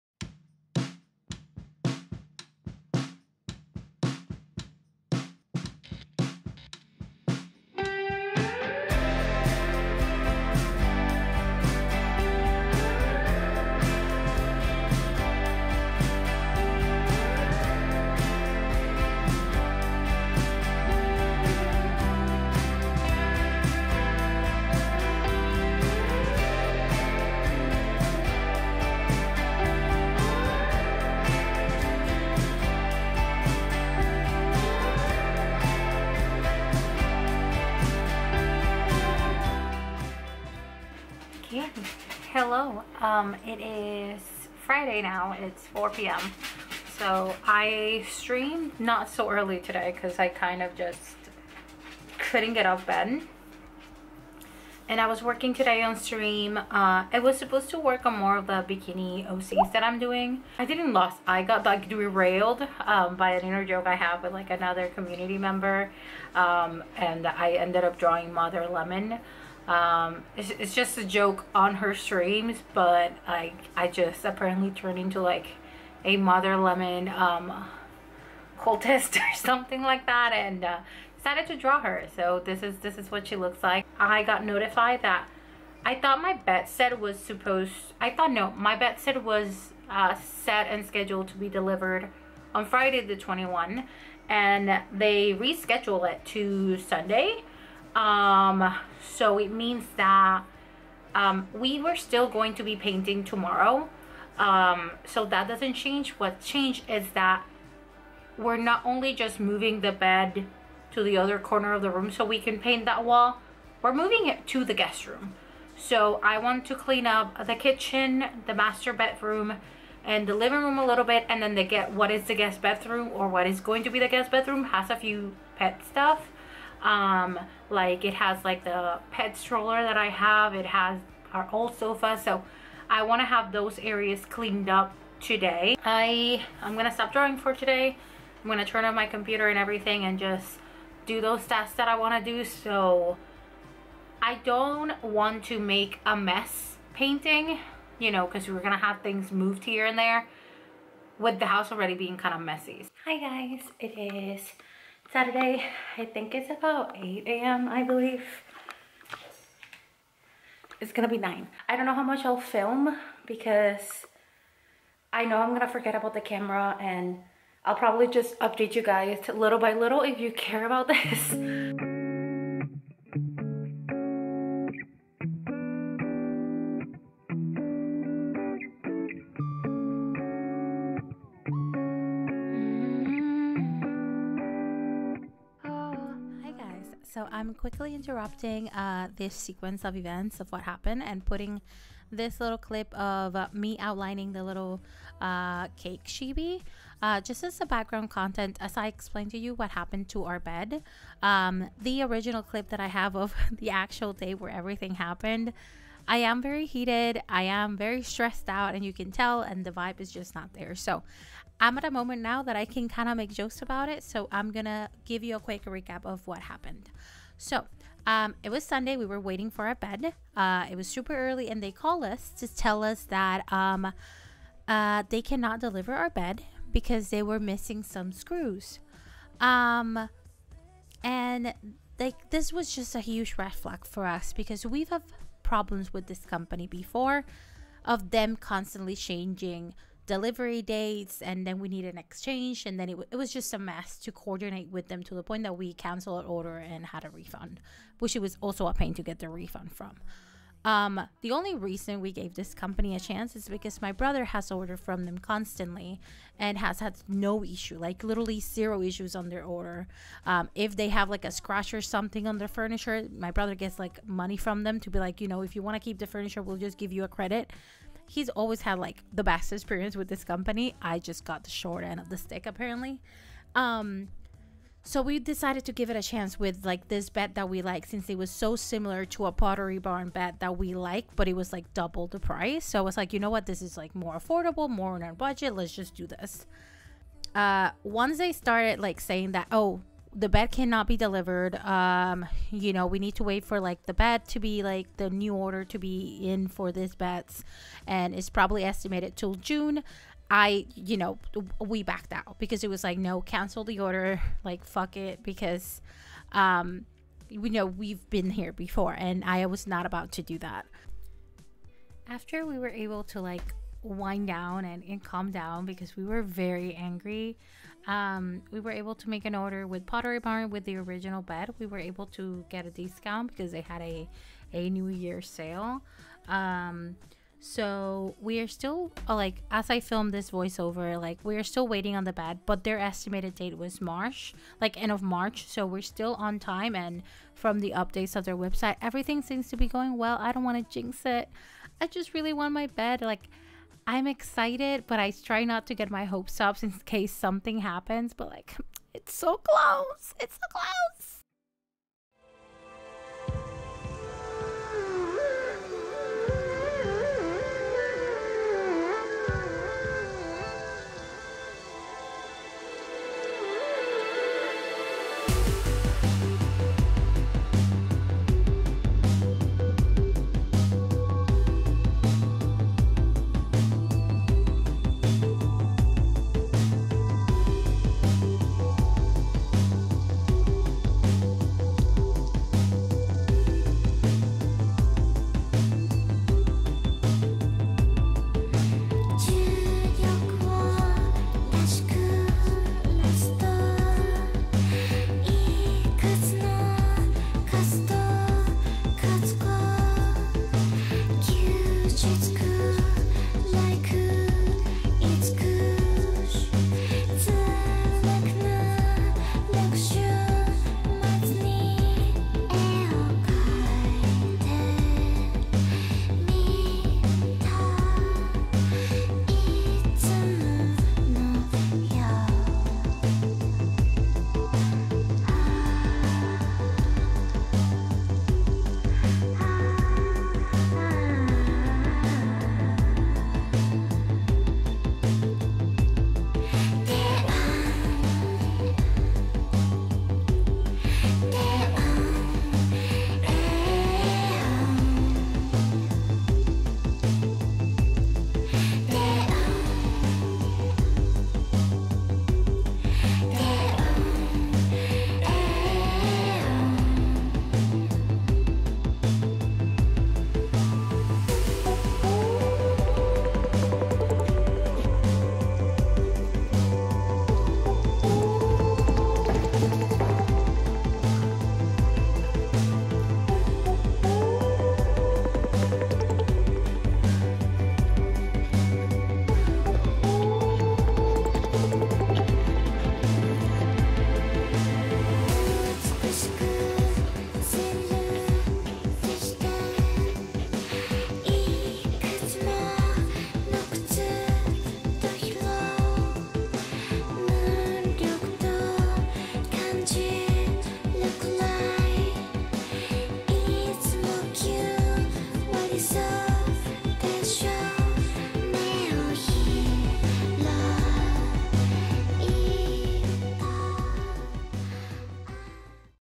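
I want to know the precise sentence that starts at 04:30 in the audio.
I just got the short end of the stick apparently.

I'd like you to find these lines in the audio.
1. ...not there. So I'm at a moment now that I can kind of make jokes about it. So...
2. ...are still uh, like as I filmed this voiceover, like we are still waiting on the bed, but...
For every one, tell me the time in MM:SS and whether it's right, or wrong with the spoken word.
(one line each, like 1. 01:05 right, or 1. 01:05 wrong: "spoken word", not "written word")
1. 03:30 right
2. 05:28 right.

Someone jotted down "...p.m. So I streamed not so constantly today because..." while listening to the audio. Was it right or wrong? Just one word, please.
wrong.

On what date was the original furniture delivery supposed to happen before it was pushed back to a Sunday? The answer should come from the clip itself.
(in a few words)
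Friday the 21.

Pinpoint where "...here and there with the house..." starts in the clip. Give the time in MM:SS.
02:29.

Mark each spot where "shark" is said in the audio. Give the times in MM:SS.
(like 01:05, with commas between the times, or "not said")
not said.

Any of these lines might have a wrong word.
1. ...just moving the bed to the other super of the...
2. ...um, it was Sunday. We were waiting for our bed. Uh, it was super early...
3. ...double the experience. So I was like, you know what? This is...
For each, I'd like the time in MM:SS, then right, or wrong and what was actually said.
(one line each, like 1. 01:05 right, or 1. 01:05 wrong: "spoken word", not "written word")
1. 01:49 wrong: "corner", not "super"
2. 03:38 right
3. 04:41 wrong: "price", not "experience".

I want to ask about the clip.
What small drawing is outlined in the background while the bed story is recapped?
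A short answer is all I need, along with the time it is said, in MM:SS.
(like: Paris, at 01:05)
cake chibi, at 03:15.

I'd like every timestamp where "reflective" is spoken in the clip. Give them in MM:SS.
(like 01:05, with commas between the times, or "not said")
not said.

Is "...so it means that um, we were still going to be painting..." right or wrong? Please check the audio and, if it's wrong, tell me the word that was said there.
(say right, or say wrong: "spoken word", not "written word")
right.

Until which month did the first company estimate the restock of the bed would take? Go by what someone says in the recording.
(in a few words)
June.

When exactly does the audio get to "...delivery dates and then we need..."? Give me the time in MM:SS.
04:00.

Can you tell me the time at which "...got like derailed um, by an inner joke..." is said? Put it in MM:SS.
01:01.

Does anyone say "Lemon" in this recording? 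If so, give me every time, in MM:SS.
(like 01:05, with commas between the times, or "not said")
01:08, 01:16.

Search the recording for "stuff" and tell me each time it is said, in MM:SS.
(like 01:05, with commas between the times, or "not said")
02:05.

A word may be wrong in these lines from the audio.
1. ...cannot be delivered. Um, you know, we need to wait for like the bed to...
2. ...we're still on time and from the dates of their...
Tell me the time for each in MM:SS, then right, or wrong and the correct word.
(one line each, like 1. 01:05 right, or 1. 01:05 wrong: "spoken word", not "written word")
1. 04:50 right
2. 05:35 wrong: "updates", not "dates".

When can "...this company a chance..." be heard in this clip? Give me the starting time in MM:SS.
04:12.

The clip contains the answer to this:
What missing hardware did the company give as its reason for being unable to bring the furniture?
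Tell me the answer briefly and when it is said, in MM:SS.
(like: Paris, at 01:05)
screws, at 03:48.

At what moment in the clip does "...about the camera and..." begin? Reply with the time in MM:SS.
02:45.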